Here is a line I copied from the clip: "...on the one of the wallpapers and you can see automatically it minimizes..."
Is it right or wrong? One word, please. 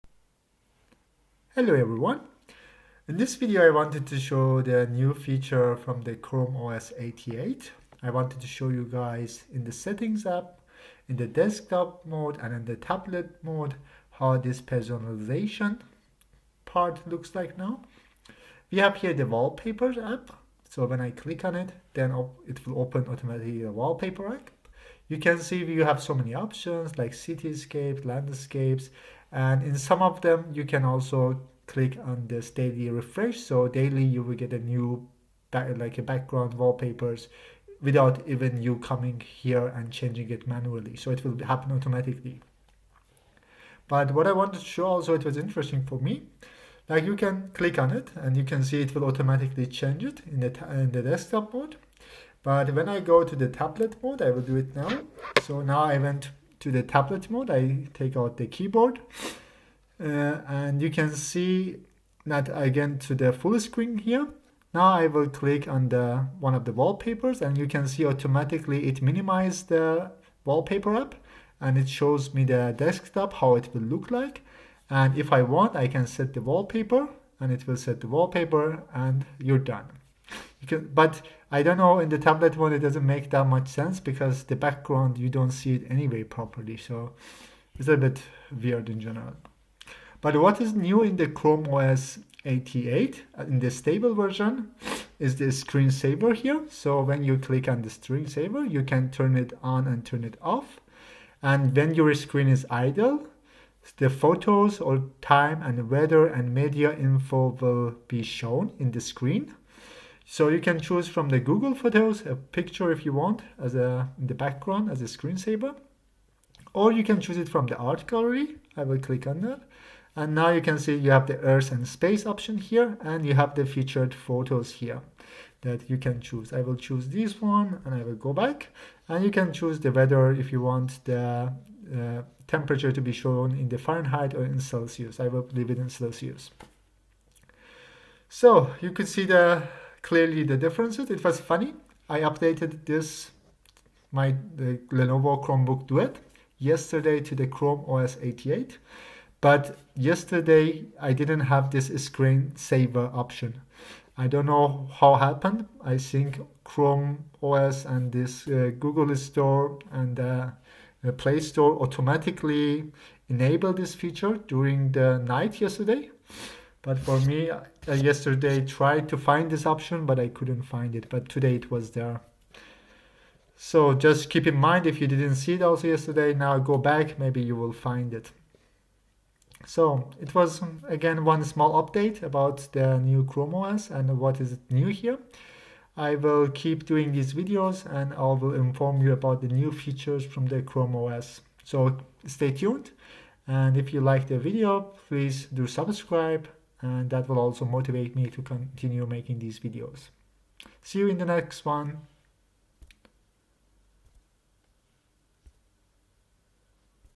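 right.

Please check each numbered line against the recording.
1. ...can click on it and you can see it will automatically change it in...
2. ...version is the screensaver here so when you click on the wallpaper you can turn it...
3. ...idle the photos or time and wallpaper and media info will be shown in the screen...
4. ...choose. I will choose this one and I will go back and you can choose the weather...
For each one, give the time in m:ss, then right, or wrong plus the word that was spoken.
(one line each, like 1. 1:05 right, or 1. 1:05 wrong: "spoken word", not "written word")
1. 0:47 right
2. 1:34 wrong: "screensaver", not "wallpaper"
3. 1:42 wrong: "weather", not "wallpaper"
4. 2:06 right.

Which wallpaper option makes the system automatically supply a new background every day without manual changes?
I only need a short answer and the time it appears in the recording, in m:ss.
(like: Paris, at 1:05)
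Daily refresh, at 0:32.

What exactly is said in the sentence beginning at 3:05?
I will keep doing these videos and I will inform you about the new features from the Chrome OS.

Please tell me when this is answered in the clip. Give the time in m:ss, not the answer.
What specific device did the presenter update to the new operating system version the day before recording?
2:24.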